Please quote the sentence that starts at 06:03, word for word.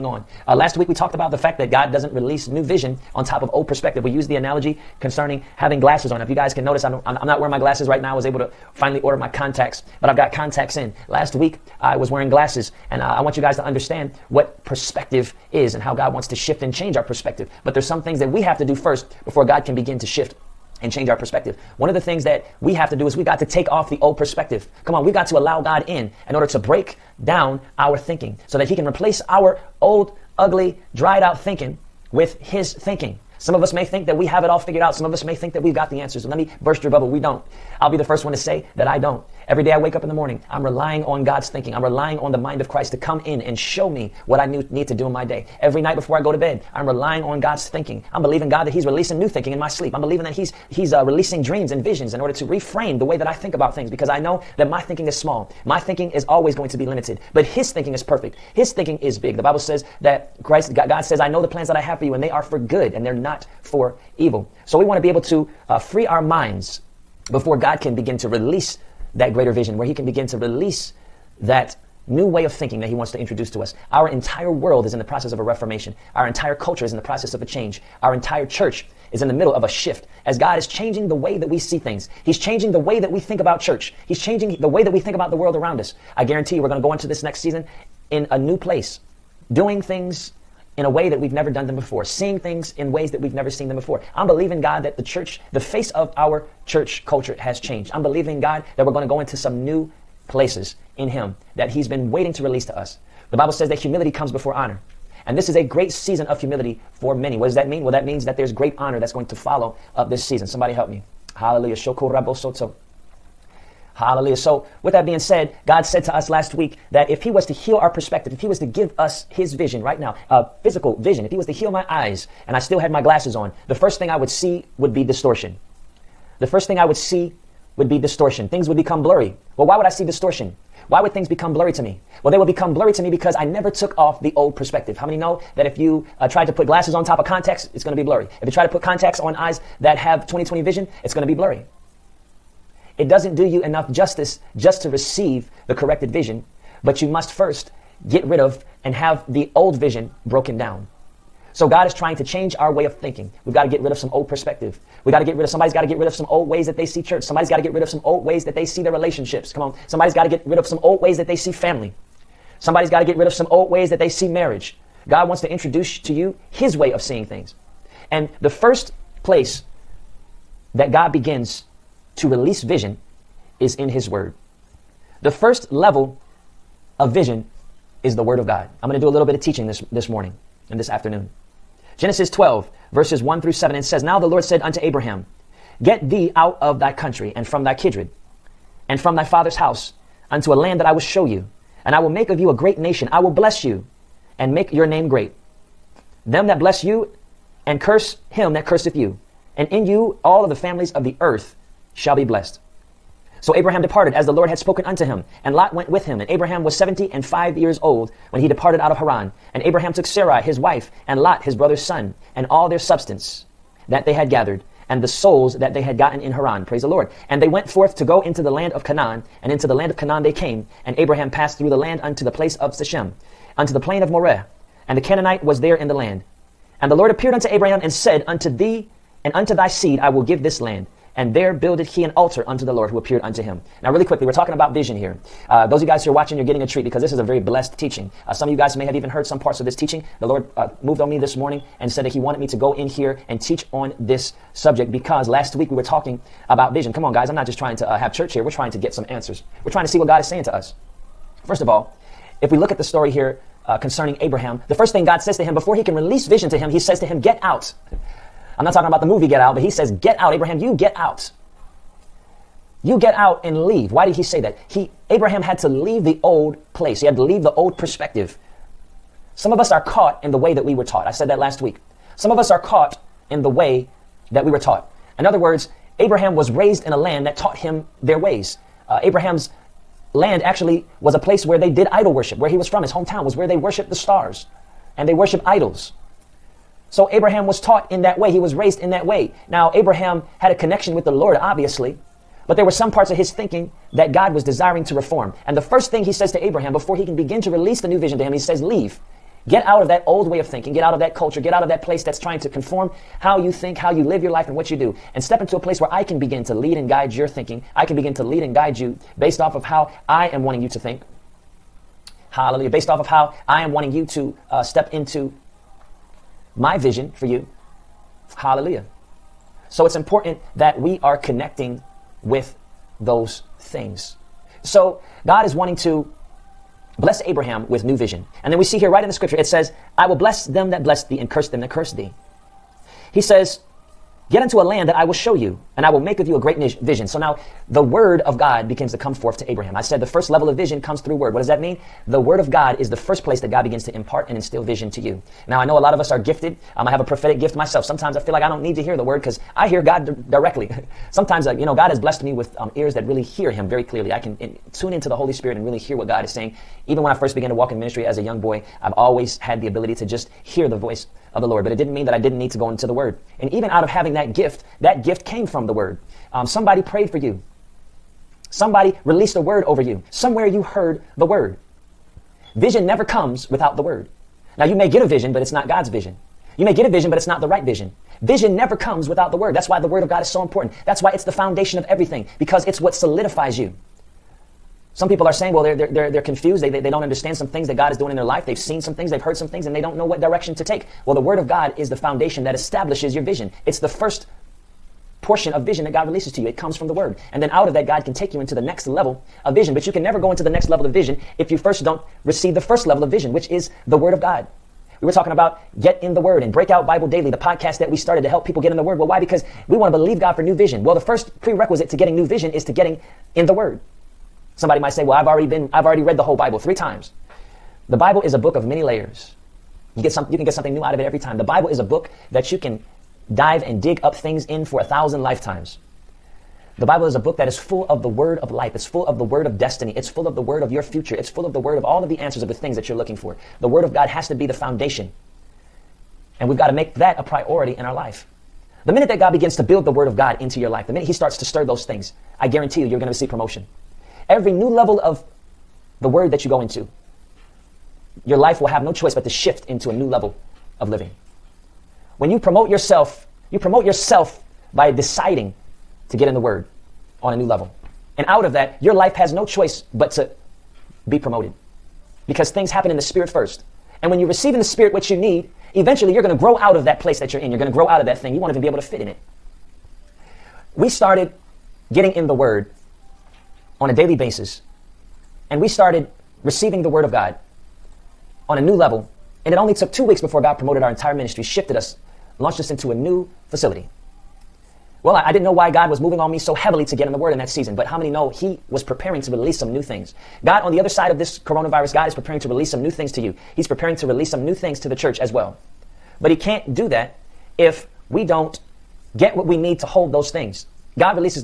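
And even out of having that gift, that gift came from the Word.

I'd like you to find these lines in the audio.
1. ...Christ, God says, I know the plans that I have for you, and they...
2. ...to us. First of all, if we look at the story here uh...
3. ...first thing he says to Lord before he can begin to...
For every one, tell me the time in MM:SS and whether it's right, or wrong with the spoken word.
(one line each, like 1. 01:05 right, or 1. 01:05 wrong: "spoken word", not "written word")
1. 01:00 right
2. 04:10 right
3. 04:55 wrong: "Abraham", not "Lord".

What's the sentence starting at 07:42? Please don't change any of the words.
Because things happen in the Spirit first.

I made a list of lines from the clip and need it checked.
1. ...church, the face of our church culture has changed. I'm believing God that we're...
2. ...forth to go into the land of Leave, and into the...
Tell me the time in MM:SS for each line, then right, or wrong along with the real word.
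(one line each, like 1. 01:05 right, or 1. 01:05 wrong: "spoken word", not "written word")
1. 01:35 right
2. 03:37 wrong: "Canaan", not "Leave".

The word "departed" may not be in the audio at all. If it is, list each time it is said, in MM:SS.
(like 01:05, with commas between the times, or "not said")
03:23, 03:28.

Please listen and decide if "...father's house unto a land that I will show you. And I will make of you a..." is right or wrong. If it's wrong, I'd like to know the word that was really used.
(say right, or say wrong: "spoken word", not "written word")
right.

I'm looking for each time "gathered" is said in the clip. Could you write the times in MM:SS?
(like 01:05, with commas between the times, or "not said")
03:34.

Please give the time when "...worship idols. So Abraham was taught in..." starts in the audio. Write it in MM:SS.
04:45.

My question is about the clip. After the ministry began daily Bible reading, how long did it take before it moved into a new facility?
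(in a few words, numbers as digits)
2 weeks.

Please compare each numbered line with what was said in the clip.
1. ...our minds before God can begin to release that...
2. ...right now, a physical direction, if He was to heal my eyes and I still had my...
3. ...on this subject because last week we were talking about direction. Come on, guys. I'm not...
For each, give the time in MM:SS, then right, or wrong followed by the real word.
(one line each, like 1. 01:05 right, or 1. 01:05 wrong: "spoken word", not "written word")
1. 01:06 right
2. 01:59 wrong: "vision", not "direction"
3. 04:03 wrong: "vision", not "direction".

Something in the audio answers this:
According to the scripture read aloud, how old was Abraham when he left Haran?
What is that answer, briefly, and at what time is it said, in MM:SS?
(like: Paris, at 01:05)
75, at 03:26.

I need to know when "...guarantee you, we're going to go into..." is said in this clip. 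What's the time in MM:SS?
01:26.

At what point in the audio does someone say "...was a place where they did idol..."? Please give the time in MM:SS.
04:41.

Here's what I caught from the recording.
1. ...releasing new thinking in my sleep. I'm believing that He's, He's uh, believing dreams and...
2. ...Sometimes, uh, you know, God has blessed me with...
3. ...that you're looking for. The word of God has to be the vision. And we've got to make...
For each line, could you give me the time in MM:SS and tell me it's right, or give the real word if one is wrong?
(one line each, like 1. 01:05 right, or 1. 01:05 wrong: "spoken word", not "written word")
1. 00:48 wrong: "releasing", not "believing"
2. 05:51 right
3. 07:12 wrong: "foundation", not "vision".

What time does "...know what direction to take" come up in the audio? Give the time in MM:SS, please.
06:29.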